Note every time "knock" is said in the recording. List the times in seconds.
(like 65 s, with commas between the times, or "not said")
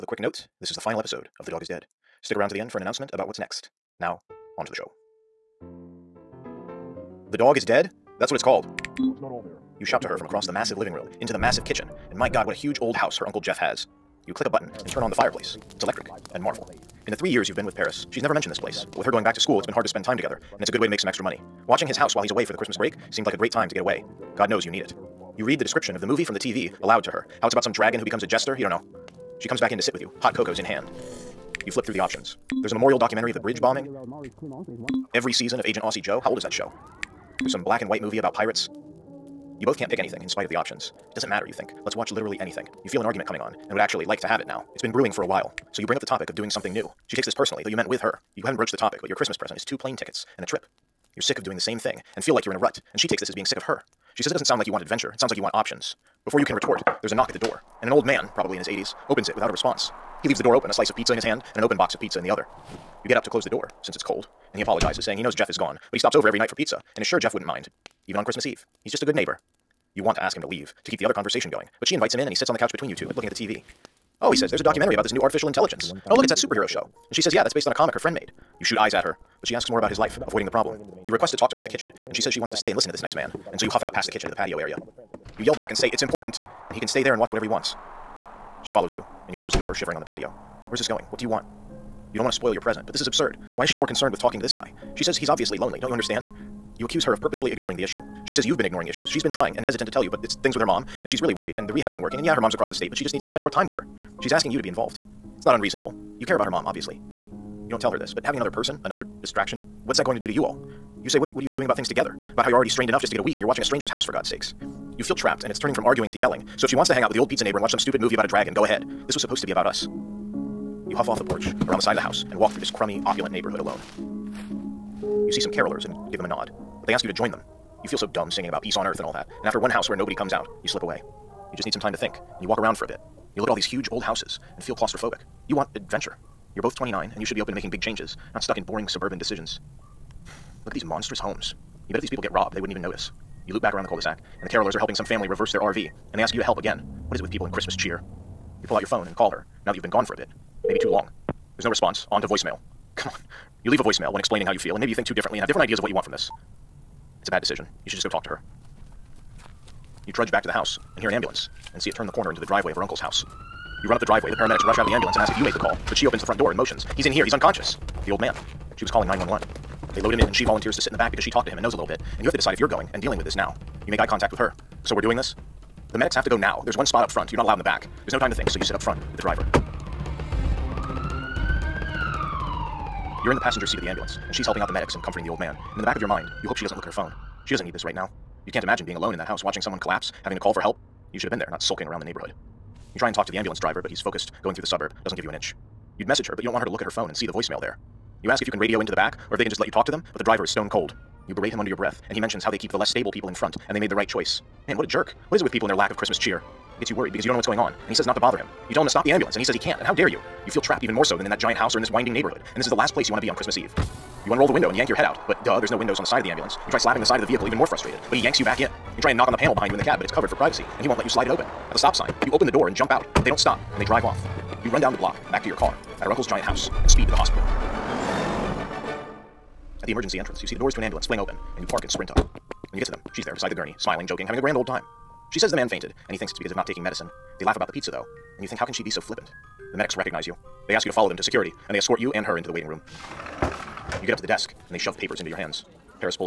57 s, 219 s.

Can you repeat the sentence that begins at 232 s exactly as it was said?
When you get to them, she's there beside the gurney, smiling, joking, having a grand old time.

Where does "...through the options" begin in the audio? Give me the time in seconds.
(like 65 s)
31 s.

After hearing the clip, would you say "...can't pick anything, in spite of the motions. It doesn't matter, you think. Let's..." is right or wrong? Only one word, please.
wrong.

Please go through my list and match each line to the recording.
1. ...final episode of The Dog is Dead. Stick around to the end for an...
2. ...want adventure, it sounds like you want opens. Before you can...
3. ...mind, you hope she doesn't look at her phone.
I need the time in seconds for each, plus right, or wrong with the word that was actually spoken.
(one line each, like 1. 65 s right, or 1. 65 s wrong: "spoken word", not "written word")
1. 0 s right
2. 54 s wrong: "options", not "opens"
3. 186 s right.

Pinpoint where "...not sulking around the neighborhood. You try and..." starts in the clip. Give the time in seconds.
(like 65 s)
191 s.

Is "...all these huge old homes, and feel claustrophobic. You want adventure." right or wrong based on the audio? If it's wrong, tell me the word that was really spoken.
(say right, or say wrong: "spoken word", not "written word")
wrong: "houses", not "homes".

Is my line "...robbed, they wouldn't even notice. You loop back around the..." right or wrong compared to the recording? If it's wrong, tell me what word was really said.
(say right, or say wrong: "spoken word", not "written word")
right.